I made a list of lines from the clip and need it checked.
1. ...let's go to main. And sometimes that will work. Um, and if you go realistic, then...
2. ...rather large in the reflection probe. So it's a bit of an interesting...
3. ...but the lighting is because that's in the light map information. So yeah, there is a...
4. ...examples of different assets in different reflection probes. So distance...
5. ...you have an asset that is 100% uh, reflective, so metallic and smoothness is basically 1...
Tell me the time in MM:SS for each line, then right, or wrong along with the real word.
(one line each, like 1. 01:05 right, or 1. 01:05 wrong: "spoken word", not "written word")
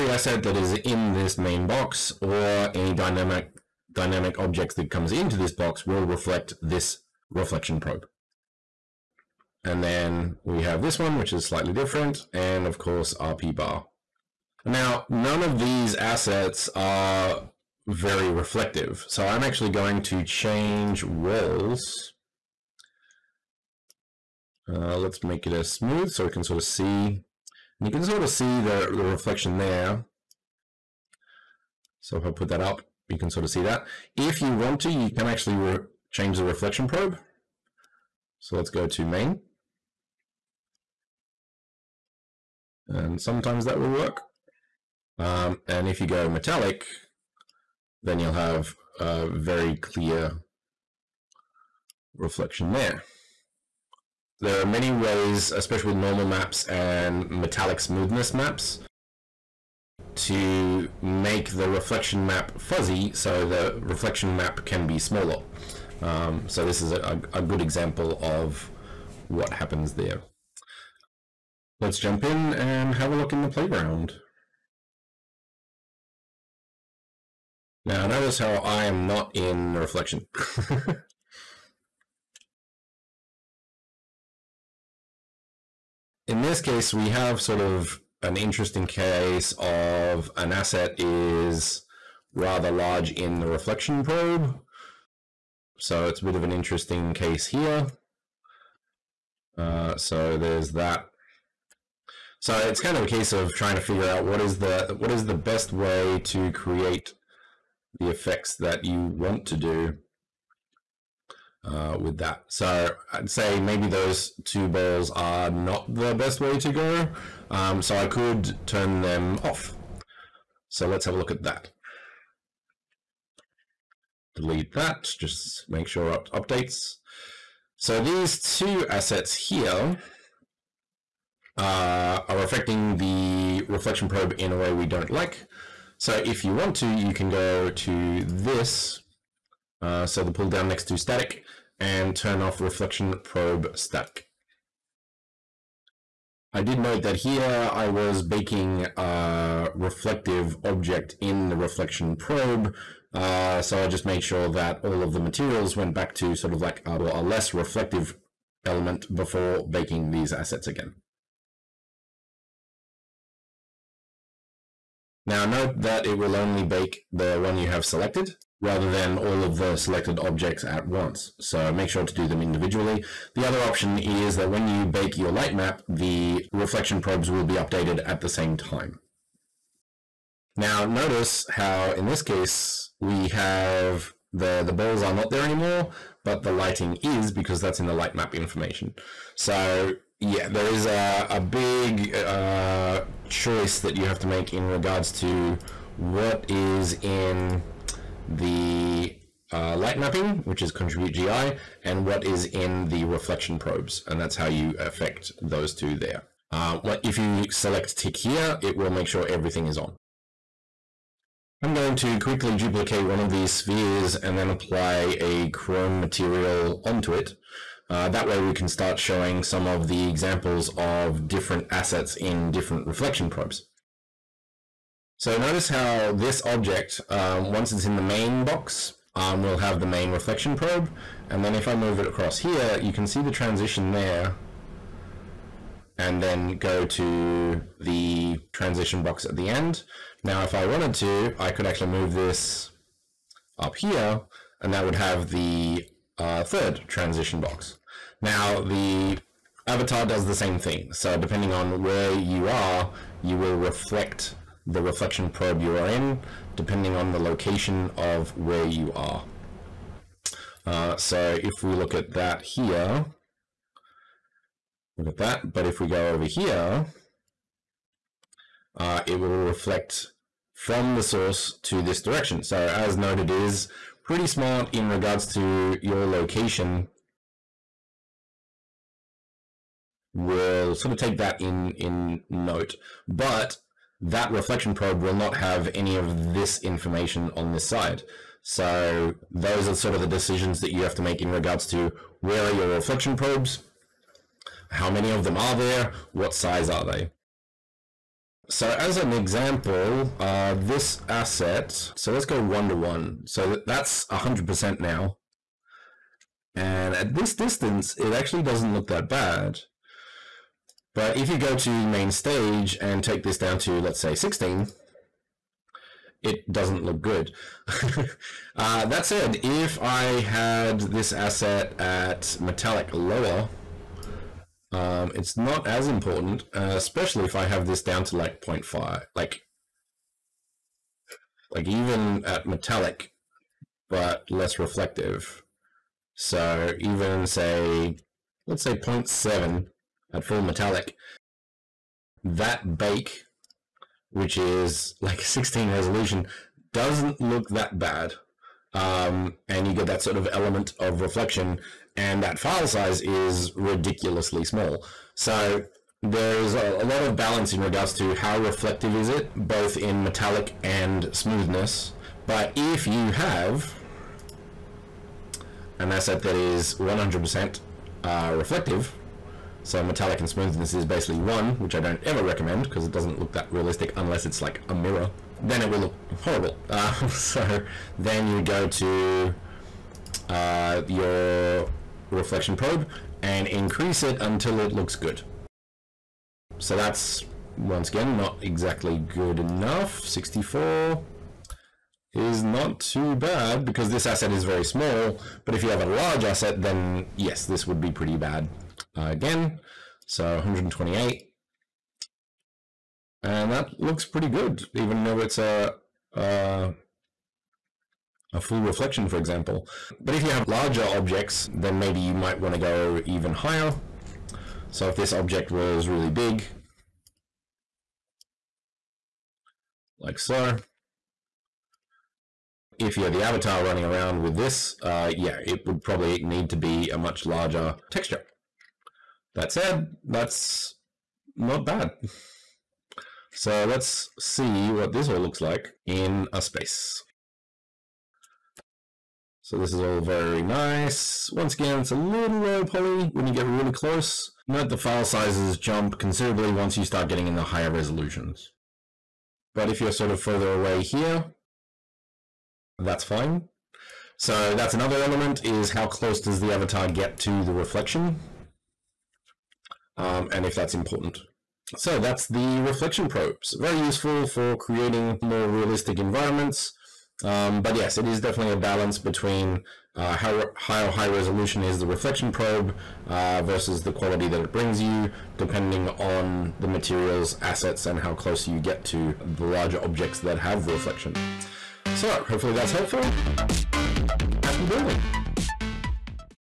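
1. 00:38 wrong: "metallic", not "realistic"
2. 01:32 right
3. 03:06 right
4. 03:40 wrong: "notice", not "distance"
5. 06:02 right.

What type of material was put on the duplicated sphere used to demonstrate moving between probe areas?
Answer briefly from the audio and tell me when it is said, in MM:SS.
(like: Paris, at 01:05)
chrome, at 03:35.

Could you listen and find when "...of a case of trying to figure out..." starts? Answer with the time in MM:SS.
01:42.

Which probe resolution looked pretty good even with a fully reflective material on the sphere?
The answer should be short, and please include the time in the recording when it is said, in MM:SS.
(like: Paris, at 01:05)
128, at 06:40.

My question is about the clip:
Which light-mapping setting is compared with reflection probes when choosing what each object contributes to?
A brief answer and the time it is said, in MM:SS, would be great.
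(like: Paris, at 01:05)
contribute GI, at 03:20.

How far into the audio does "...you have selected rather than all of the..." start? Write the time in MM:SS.
02:47.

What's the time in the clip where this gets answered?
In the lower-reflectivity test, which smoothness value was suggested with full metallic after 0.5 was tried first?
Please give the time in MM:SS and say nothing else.
05:38.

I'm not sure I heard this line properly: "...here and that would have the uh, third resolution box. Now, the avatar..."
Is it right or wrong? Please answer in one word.
wrong.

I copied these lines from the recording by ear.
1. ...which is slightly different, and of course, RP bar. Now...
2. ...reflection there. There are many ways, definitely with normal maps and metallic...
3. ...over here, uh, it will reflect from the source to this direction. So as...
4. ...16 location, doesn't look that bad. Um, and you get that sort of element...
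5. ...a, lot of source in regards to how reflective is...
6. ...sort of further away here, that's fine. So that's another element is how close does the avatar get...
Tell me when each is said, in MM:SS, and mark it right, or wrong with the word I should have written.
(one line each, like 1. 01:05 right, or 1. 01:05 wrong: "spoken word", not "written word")
1. 00:11 right
2. 00:52 wrong: "especially", not "definitely"
3. 04:26 right
4. 05:45 wrong: "resolution", not "location"
5. 05:56 wrong: "balance", not "source"
6. 07:29 right.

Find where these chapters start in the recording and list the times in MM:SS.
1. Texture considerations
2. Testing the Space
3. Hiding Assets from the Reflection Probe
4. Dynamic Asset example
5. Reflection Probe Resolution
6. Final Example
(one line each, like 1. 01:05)
1. 00:55
2. 01:10
3. 02:06
4. 03:30
5. 04:56
6. 07:13.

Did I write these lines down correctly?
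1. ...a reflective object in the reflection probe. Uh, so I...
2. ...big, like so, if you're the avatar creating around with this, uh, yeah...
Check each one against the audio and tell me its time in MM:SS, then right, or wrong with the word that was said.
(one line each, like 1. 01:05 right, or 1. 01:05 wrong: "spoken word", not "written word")
1. 02:28 right
2. 06:56 wrong: "running", not "creating".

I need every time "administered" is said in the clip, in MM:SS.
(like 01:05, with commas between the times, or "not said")
not said.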